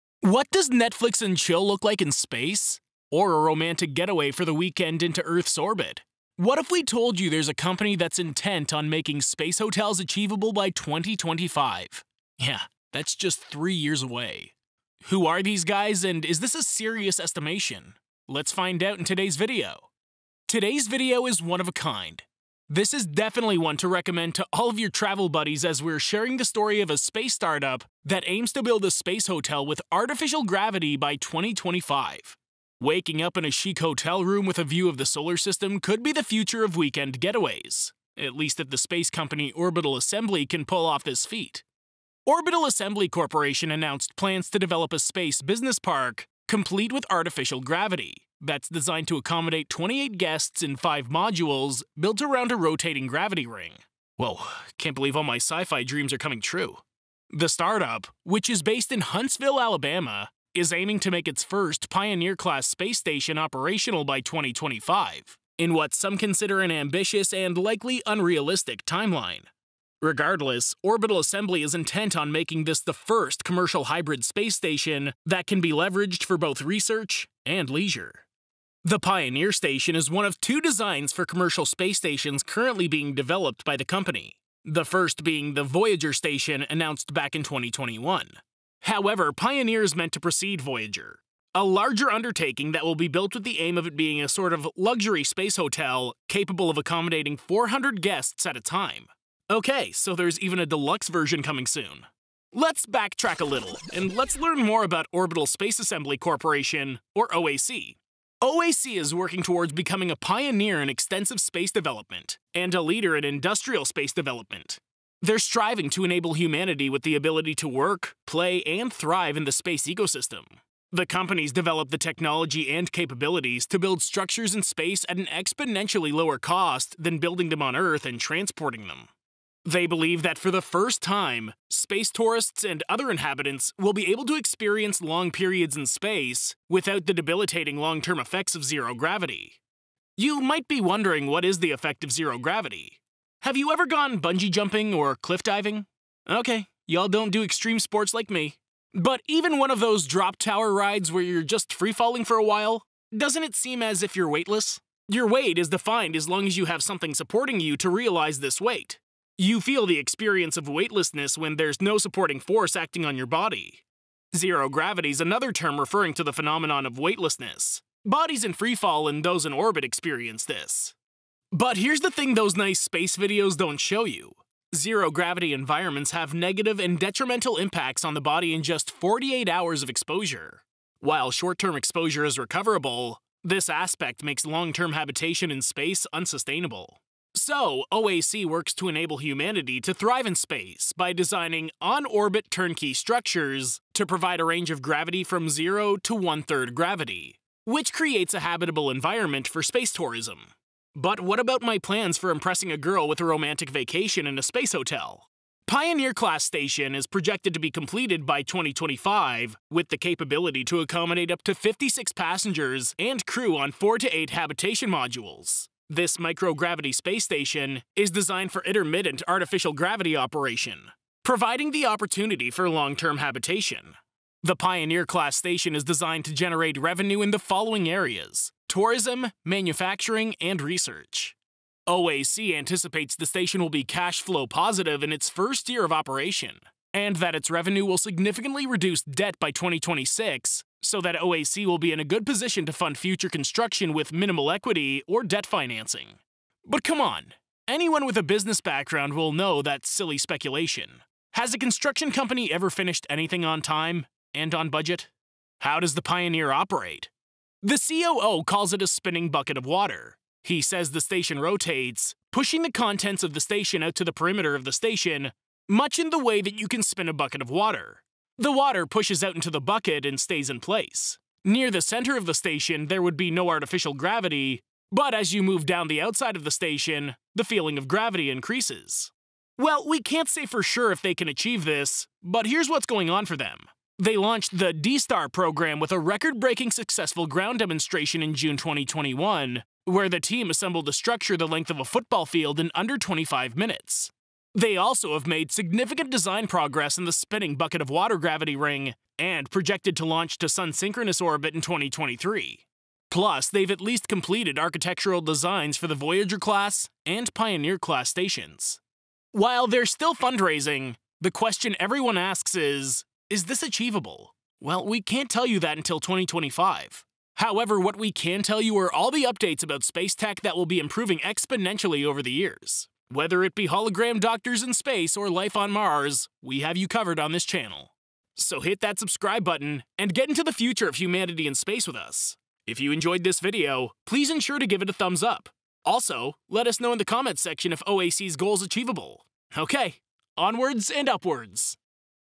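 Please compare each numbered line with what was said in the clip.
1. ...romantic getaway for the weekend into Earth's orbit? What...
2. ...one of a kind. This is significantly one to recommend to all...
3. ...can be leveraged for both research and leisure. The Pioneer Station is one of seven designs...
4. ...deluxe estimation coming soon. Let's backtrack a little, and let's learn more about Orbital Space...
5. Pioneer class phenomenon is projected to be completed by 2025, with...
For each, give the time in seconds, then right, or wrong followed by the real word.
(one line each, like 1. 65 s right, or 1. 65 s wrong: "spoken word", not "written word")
1. 3 s right
2. 21 s wrong: "definitely", not "significantly"
3. 75 s wrong: "two", not "seven"
4. 100 s wrong: "version", not "estimation"
5. 205 s wrong: "station", not "phenomenon".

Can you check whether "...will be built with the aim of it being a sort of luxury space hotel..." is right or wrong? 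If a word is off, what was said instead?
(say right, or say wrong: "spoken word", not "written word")
right.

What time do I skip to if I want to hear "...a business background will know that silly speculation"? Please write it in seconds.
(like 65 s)
248 s.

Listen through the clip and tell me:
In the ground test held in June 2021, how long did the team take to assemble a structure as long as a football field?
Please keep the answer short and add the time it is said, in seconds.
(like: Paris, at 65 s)
Under 25 minutes, at 292 s.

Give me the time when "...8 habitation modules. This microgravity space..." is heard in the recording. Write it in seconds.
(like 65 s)
214 s.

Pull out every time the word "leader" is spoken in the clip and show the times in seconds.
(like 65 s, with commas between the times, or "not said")
112 s.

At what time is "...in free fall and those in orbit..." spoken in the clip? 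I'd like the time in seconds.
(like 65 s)
168 s.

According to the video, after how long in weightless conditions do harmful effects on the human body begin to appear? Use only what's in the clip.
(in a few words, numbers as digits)
48 hours.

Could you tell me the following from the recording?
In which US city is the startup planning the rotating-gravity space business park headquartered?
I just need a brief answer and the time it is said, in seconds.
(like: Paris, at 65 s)
Huntsville, Alabama, at 59 s.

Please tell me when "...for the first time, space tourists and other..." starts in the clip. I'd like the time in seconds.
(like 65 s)
130 s.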